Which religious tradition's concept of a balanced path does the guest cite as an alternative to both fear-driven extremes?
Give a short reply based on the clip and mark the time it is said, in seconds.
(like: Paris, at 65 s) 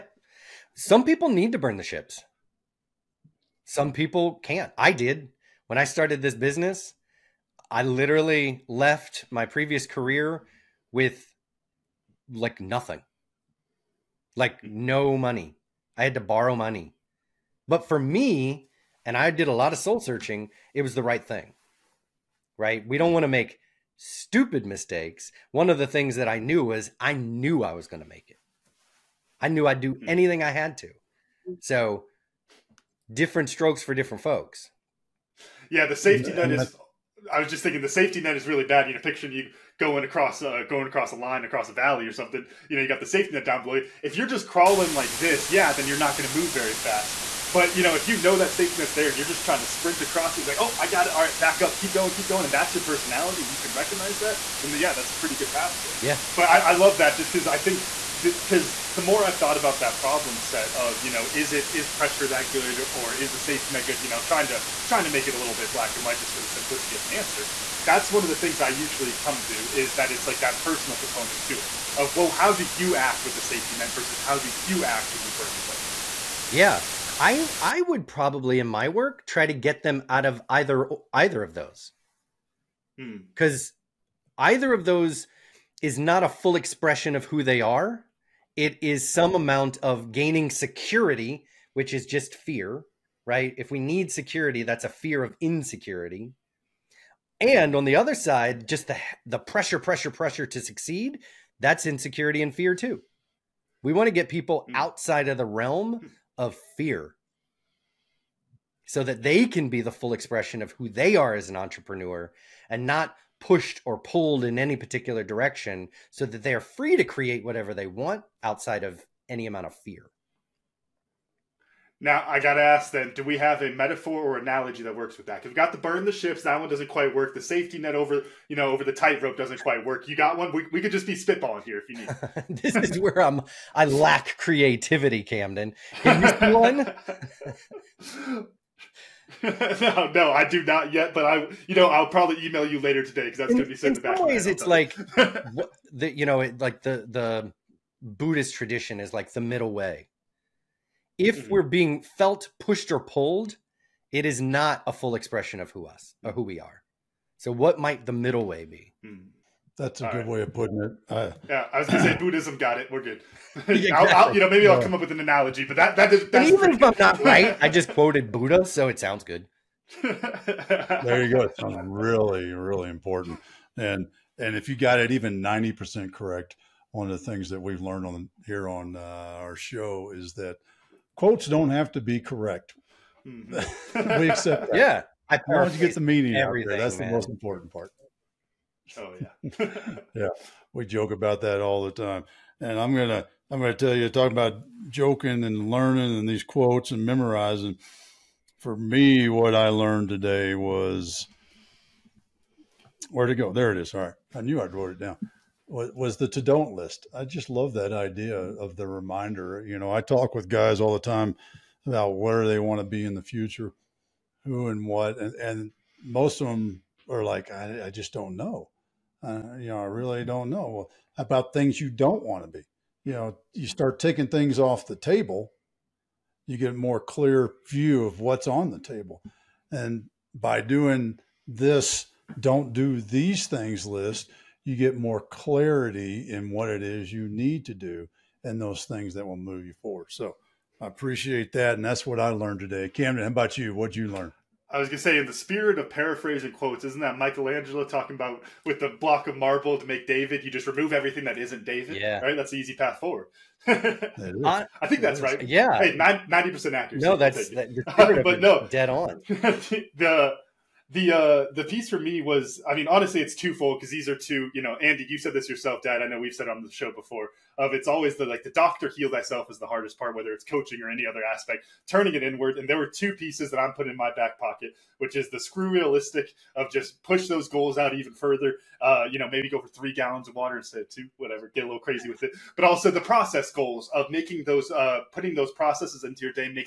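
Buddhist, at 148 s.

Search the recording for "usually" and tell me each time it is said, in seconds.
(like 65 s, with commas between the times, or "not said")
68 s.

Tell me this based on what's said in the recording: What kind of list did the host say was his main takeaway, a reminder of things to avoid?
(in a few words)
to don't list.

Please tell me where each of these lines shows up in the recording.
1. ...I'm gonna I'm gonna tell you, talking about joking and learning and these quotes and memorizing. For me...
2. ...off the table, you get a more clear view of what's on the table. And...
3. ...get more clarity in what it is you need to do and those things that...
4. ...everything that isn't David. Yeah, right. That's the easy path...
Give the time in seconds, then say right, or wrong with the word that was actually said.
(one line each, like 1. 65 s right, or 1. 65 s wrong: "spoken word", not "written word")
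1. 192 s right
2. 224 s right
3. 234 s right
4. 250 s right.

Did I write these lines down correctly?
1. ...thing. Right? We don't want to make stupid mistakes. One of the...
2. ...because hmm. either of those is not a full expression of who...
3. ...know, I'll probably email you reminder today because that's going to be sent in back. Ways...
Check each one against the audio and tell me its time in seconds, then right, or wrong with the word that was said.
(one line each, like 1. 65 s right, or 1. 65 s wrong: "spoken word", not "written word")
1. 21 s right
2. 82 s right
3. 141 s wrong: "later", not "reminder".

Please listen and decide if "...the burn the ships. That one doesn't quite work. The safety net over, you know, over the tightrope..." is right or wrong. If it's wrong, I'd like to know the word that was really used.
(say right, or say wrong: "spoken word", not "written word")
right.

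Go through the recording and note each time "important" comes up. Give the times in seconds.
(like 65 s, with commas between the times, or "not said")
172 s, 187 s.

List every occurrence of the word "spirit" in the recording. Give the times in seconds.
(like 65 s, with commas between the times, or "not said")
245 s.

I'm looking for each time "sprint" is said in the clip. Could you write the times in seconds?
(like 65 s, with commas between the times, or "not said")
49 s.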